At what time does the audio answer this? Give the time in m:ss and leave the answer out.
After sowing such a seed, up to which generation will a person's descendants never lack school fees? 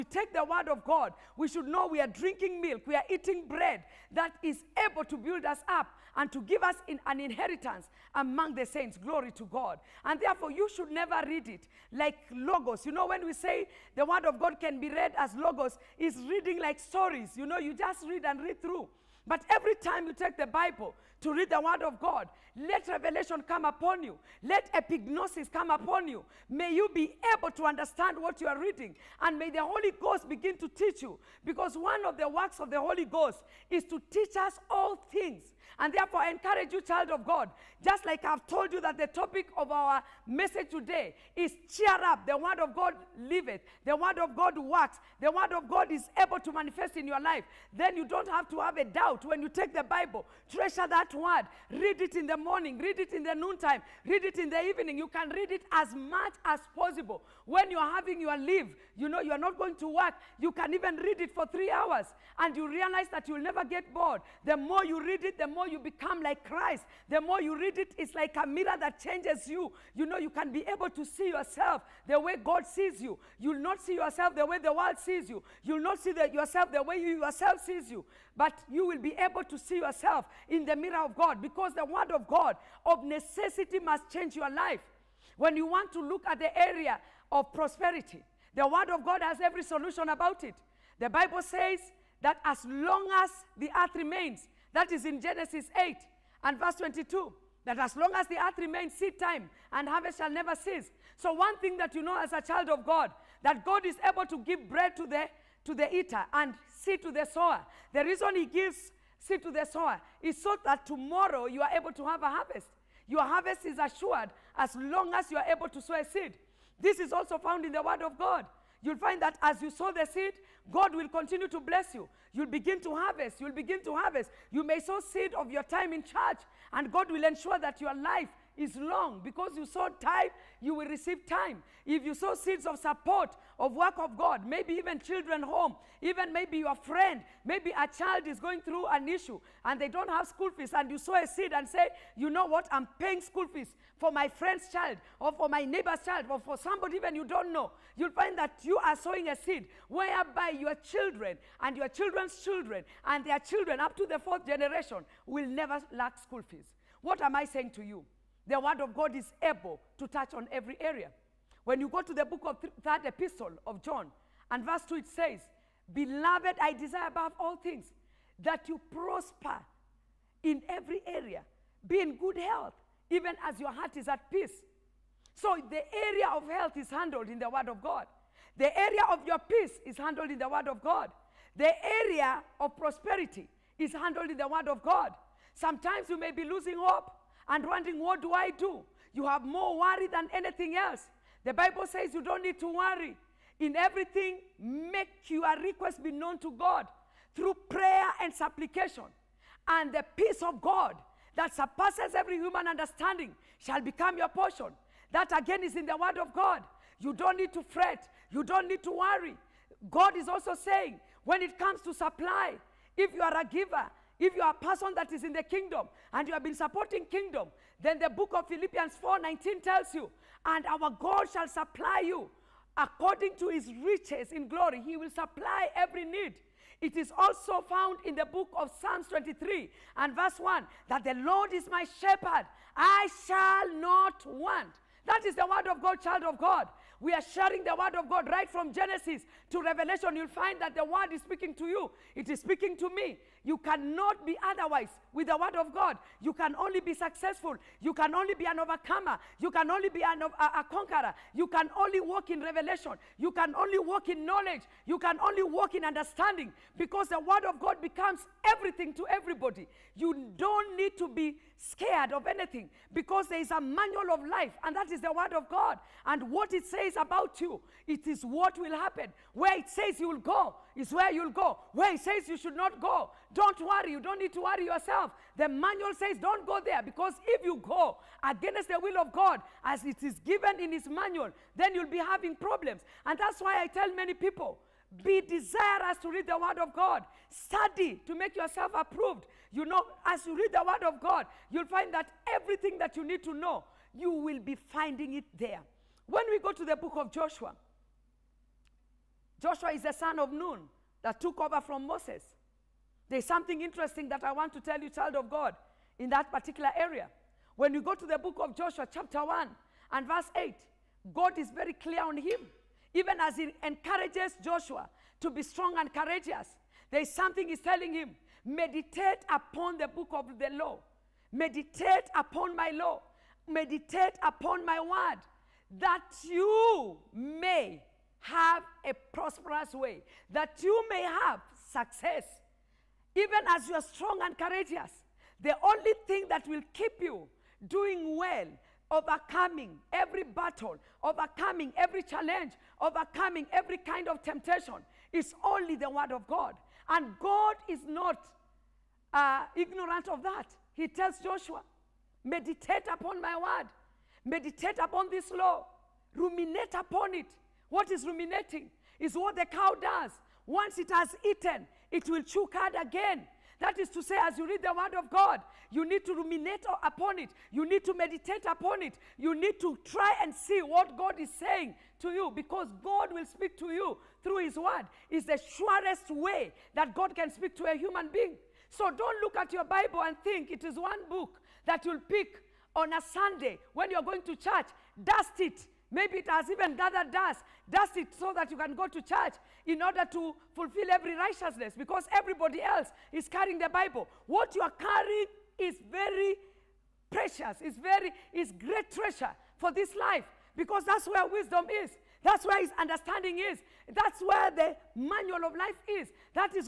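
2:34.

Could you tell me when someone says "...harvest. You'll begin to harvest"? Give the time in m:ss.
2:02.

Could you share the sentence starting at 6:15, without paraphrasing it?
It's the surest way that God can speak to a human being.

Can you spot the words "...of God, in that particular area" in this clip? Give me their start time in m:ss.
5:05.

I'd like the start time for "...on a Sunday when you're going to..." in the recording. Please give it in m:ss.
6:22.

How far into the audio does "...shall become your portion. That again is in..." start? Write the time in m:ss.
3:23.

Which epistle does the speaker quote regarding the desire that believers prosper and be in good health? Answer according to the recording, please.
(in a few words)
Third epistle of John.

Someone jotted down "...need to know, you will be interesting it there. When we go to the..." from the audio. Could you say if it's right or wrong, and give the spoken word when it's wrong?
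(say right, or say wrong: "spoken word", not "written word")
wrong: "finding", not "interesting".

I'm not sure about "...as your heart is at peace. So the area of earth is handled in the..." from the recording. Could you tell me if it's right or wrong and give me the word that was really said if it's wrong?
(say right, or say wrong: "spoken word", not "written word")
wrong: "health", not "earth".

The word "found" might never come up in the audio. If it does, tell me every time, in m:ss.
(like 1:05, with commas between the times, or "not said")
1:57, 3:47.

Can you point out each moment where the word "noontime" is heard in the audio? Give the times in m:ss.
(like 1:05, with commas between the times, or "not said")
0:53.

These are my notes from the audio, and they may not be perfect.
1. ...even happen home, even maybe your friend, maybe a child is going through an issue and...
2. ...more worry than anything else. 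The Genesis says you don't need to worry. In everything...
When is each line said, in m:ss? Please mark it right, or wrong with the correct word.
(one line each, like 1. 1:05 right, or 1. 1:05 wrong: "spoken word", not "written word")
1. 2:14 wrong: "children", not "happen"
2. 3:09 wrong: "Bible", not "Genesis".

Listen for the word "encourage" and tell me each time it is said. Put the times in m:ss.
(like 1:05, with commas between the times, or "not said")
0:36, 5:13.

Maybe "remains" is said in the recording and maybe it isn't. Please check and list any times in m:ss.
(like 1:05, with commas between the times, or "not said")
1:33, 1:38.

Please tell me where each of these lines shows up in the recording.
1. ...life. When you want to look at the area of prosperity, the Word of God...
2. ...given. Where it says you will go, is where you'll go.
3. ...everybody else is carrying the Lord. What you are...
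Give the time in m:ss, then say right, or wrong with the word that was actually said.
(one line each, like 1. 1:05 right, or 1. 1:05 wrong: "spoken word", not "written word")
1. 1:24 right
2. 4:28 wrong: "happen", not "given"
3. 6:32 wrong: "Bible", not "Lord".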